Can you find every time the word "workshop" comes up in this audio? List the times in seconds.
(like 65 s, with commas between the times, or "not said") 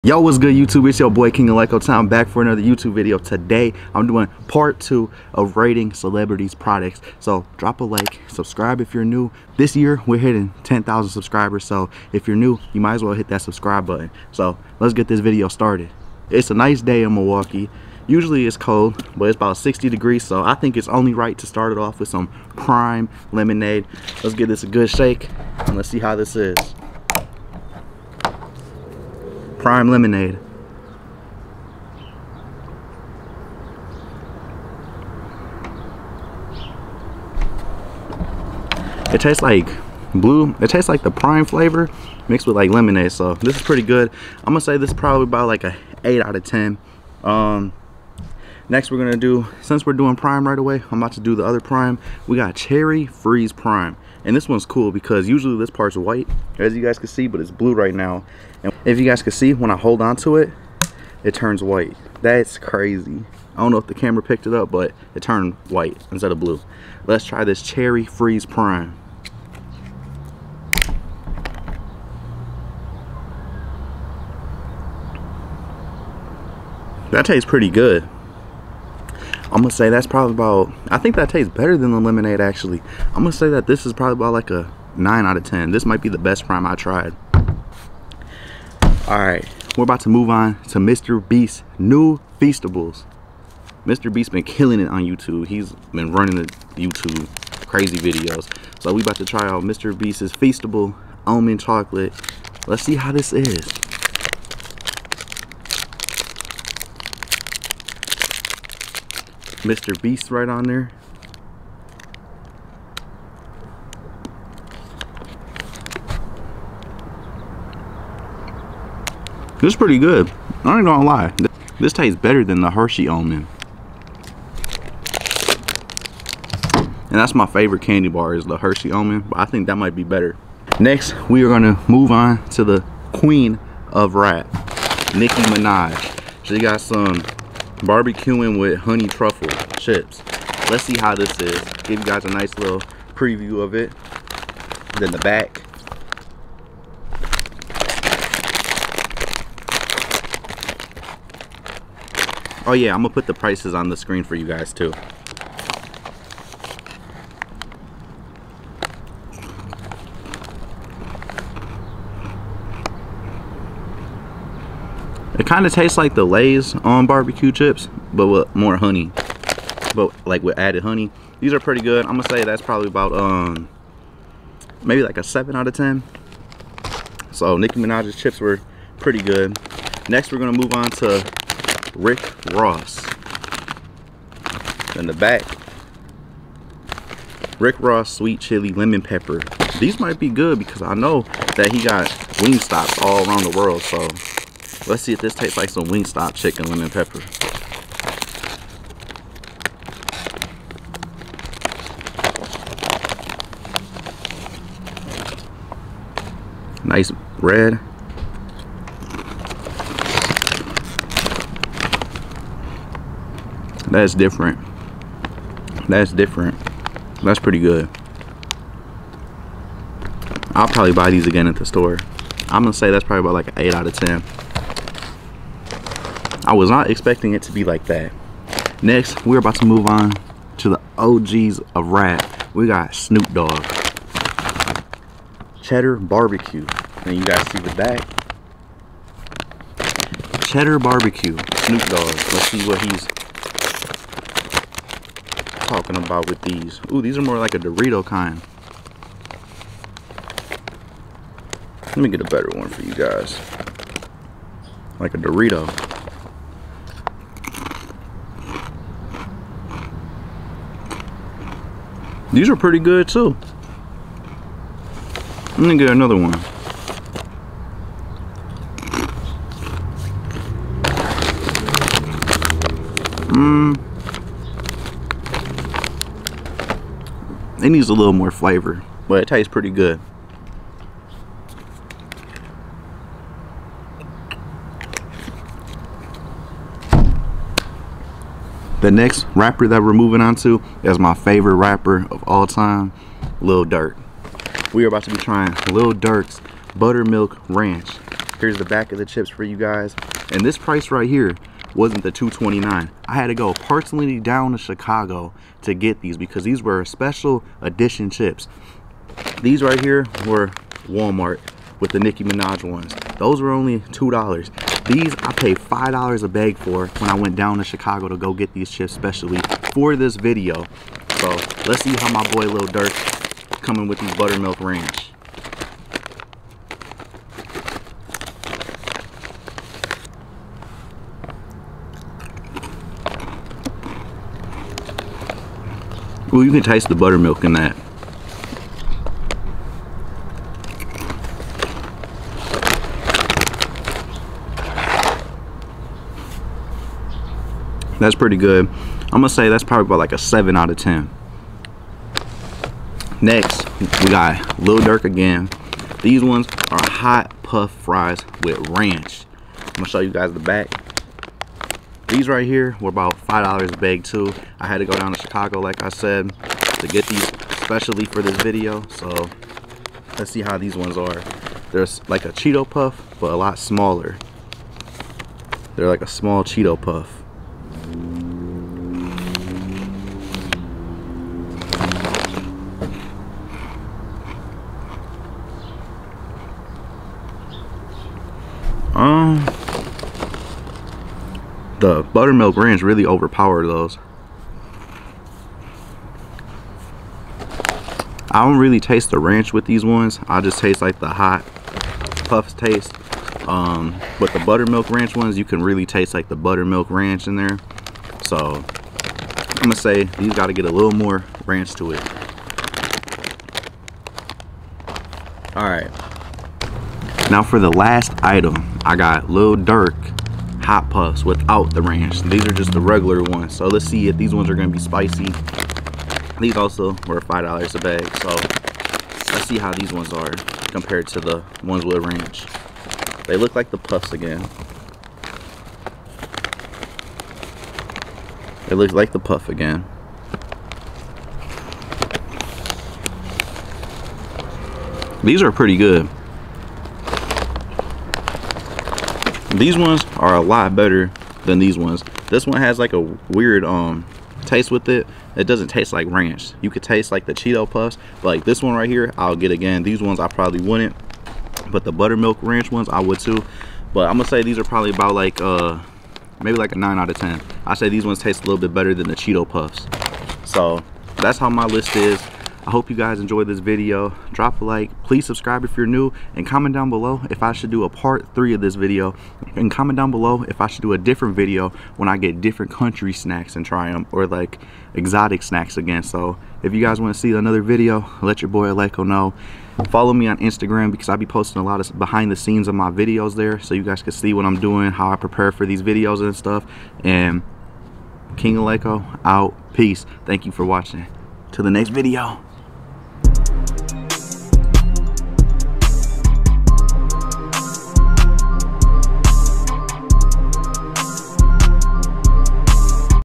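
not said.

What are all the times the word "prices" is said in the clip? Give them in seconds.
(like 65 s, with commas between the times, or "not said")
153 s, 300 s.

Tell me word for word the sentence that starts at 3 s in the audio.
Today, I'm doing part two of rating celebrities' products.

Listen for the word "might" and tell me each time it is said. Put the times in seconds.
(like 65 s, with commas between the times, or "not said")
12 s, 85 s, 129 s, 189 s.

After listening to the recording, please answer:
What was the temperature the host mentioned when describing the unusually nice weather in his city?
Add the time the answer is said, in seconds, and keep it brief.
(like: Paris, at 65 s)
60 degrees, at 19 s.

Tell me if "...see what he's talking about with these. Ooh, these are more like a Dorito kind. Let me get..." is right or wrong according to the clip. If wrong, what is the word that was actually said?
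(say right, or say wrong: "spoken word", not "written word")
right.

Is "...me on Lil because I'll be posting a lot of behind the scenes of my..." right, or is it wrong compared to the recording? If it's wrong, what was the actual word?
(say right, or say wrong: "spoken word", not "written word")
wrong: "Instagram", not "Lil".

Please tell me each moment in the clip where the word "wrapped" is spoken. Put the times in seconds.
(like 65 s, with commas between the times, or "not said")
not said.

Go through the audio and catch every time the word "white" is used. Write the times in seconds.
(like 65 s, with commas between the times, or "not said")
55 s, 61 s, 65 s.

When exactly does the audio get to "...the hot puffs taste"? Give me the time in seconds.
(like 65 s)
400 s.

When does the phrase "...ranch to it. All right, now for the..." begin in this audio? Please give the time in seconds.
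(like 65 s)
411 s.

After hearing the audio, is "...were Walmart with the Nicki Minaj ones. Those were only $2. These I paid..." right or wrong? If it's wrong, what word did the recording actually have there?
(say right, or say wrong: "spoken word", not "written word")
right.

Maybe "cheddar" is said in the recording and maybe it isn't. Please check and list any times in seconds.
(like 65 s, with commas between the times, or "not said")
235 s, 240 s.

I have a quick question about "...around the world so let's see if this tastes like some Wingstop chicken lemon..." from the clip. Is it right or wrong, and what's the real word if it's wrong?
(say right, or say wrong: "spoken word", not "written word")
right.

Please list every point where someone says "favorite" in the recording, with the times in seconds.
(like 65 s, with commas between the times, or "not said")
127 s, 291 s.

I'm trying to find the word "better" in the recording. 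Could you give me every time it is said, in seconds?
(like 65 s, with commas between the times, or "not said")
81 s, 122 s, 130 s, 252 s, 450 s, 468 s.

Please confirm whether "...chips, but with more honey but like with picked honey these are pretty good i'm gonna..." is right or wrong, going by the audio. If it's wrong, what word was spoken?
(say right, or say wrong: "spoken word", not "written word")
wrong: "added", not "picked".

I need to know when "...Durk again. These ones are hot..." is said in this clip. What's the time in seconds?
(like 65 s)
354 s.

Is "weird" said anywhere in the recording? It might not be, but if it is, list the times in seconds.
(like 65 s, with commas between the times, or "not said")
452 s.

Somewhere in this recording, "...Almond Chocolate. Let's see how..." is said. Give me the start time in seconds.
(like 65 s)
101 s.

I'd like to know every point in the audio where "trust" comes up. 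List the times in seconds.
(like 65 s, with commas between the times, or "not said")
not said.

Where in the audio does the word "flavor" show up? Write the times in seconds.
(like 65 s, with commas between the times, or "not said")
41 s, 278 s.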